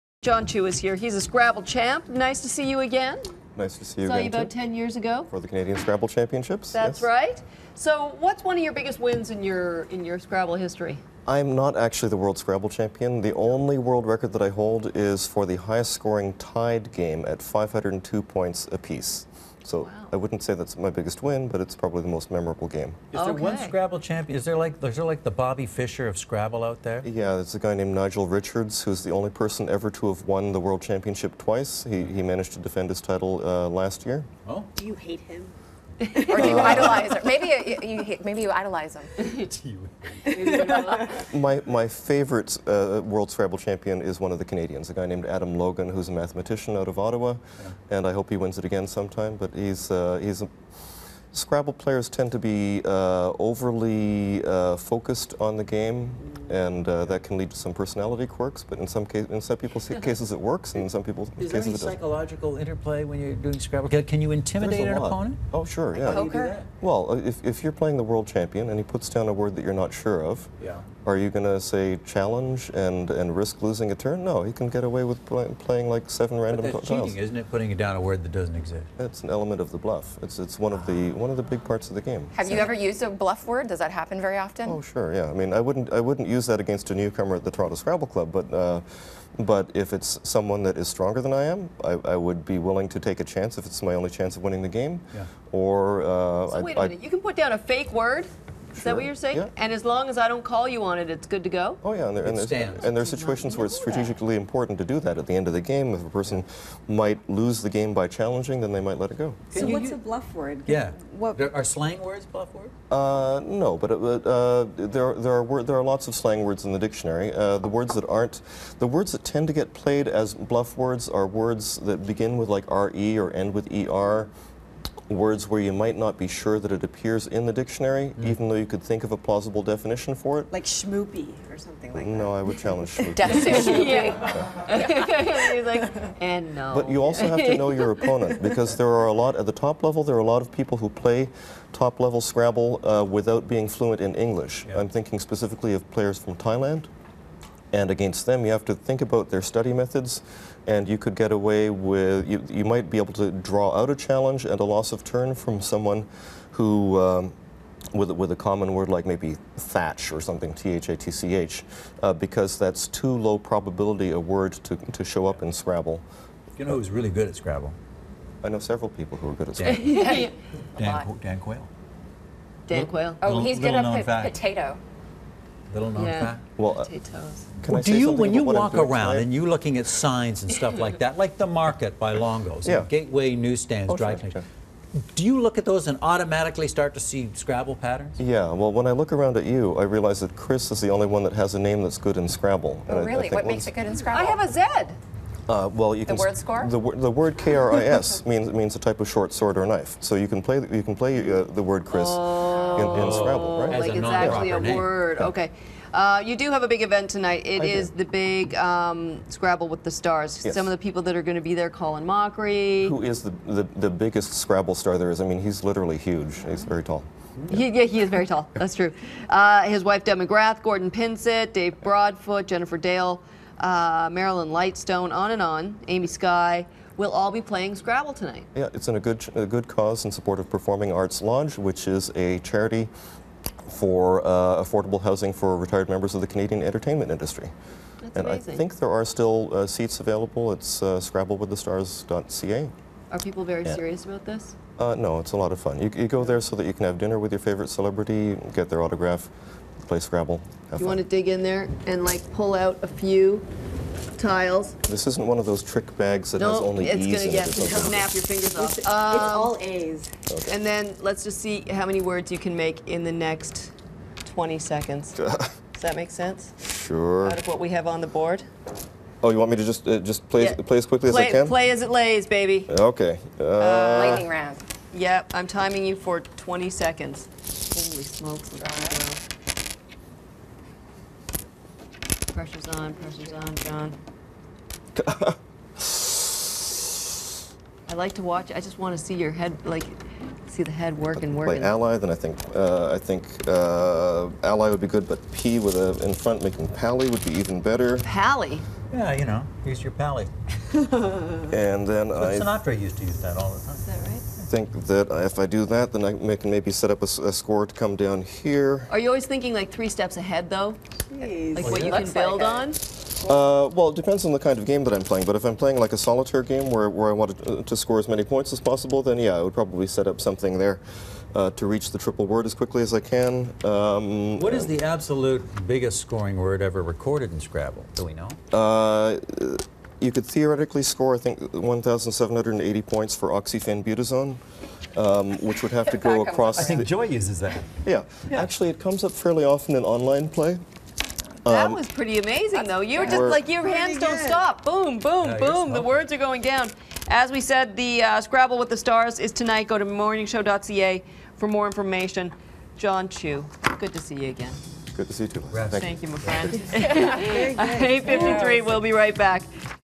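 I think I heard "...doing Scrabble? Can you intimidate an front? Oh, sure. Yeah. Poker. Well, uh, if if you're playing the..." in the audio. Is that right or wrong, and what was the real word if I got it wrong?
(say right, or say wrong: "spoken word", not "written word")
wrong: "opponent", not "front".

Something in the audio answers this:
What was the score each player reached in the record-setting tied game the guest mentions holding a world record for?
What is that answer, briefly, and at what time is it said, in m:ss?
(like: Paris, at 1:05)
502, at 0:17.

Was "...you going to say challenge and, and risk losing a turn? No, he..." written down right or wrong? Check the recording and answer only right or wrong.
right.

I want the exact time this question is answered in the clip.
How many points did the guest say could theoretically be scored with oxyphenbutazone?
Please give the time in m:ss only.
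5:31.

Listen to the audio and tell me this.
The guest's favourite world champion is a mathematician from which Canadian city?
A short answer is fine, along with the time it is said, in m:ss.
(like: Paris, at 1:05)
Ottawa, at 0:46.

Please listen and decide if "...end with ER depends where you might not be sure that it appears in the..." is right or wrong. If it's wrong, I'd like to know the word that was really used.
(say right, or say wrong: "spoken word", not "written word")
wrong: "words", not "depends".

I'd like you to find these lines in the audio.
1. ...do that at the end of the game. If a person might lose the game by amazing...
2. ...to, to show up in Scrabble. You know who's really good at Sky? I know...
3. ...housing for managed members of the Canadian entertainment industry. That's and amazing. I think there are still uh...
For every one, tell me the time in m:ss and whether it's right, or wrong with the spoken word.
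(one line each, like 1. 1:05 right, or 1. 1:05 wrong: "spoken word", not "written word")
1. 1:44 wrong: "challenging", not "amazing"
2. 2:44 wrong: "Scrabble", not "Sky"
3. 3:55 wrong: "retired", not "managed".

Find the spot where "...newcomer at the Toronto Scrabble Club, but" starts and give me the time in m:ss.
1:26.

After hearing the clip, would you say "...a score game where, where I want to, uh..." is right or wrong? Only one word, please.
wrong.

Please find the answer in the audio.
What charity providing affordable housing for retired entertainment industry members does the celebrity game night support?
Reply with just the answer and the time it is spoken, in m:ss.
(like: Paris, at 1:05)
Performing Arts Lodge, at 3:50.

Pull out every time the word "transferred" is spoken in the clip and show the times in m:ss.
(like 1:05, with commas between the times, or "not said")
not said.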